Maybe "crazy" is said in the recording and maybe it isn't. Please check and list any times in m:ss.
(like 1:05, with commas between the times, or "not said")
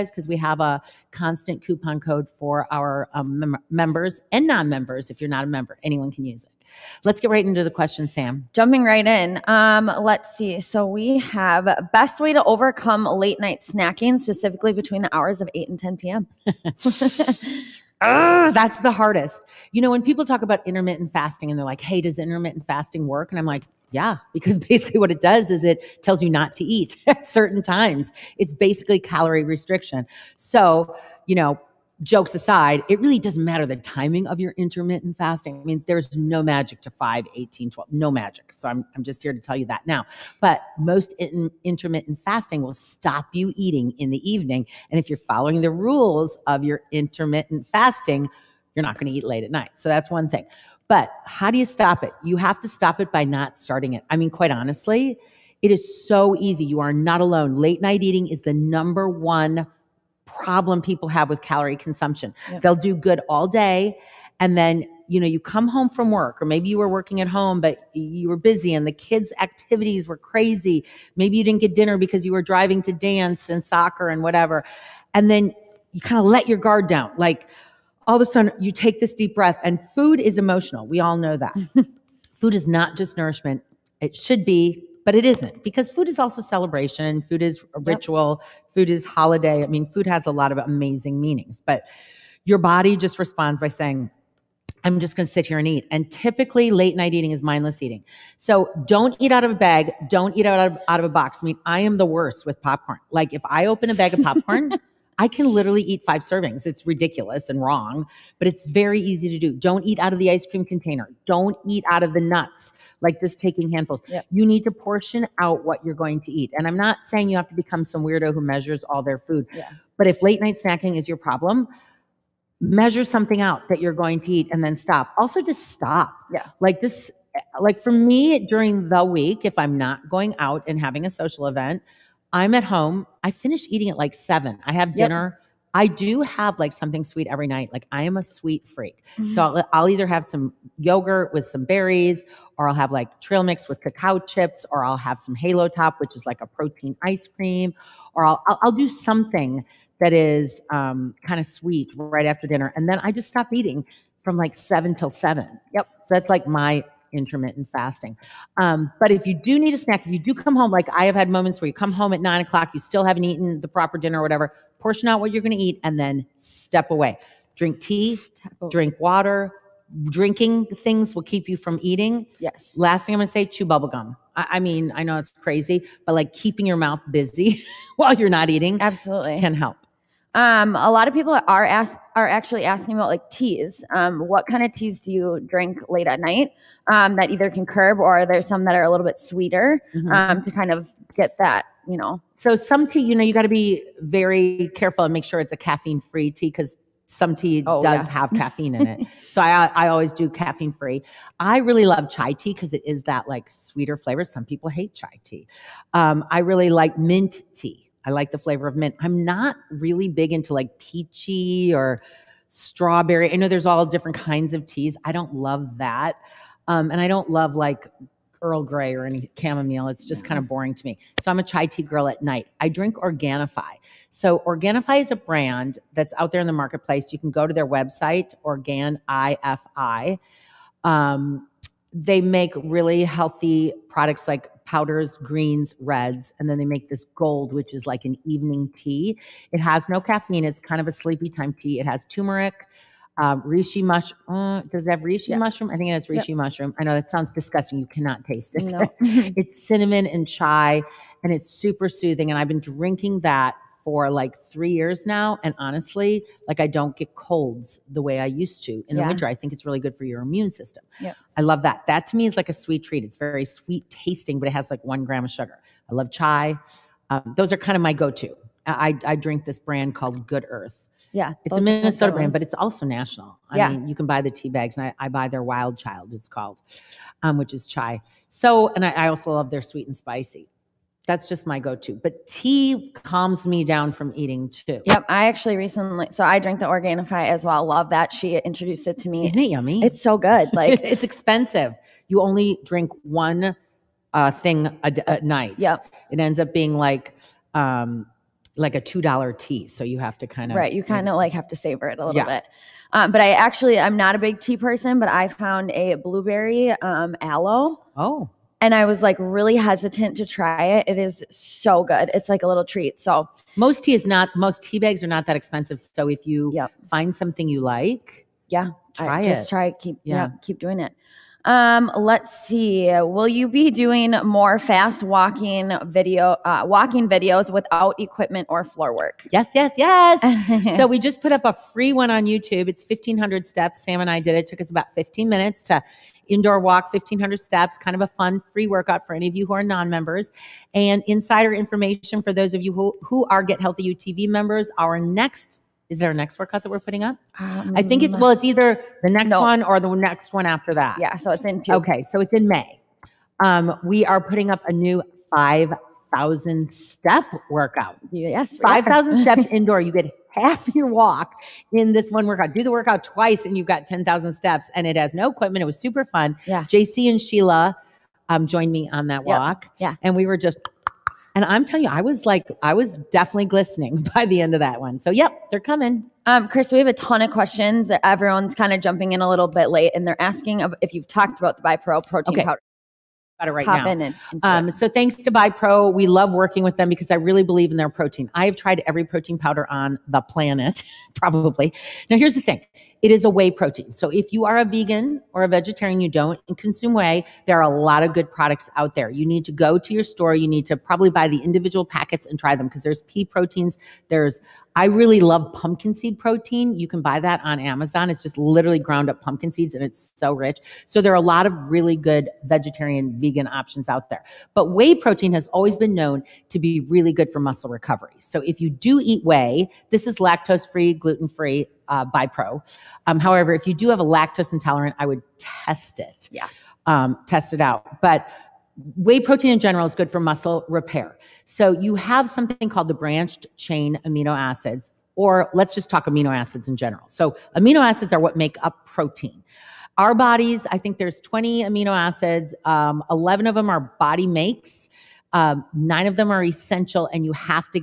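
1:10, 2:55.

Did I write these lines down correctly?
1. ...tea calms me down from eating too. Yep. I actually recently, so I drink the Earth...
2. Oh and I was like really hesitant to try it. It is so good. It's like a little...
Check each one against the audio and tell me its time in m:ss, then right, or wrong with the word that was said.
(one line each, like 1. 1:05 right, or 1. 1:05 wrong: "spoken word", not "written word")
1. 4:42 wrong: "Organifi", not "Earth"
2. 5:07 right.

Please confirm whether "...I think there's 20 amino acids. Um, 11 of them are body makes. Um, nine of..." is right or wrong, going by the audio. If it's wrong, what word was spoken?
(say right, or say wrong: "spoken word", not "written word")
right.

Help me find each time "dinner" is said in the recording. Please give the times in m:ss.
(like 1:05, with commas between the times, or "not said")
1:11, 2:14, 2:32, 2:43.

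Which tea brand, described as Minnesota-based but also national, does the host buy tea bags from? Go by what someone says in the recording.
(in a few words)
Good Earth.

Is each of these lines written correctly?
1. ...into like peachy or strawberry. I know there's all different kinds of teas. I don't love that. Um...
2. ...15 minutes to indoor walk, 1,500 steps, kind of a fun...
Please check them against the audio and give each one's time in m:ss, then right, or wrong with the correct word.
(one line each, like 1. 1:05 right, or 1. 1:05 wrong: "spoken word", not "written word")
1. 3:30 right
2. 5:34 right.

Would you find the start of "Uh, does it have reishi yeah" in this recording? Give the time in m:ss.
4:04.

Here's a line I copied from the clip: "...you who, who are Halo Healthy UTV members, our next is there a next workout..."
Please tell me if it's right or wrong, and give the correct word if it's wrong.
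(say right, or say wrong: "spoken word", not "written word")
wrong: "Get", not "Halo".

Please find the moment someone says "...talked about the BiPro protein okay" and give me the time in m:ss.
6:21.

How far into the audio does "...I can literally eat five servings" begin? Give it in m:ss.
1:45.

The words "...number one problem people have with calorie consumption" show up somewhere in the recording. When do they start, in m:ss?
0:58.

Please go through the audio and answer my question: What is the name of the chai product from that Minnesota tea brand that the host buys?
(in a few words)
Wild Child.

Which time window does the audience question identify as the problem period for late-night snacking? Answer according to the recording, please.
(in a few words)
8 and 10 p.m.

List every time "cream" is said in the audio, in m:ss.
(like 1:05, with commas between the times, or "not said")
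1:50, 2:27.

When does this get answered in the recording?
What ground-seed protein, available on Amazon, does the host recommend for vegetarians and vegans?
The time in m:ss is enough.
6:45.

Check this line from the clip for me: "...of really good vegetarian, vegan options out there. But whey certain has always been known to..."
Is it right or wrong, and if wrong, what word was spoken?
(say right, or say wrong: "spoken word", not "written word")
wrong: "protein", not "certain".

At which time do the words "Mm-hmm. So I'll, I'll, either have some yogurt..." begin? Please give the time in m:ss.
2:19.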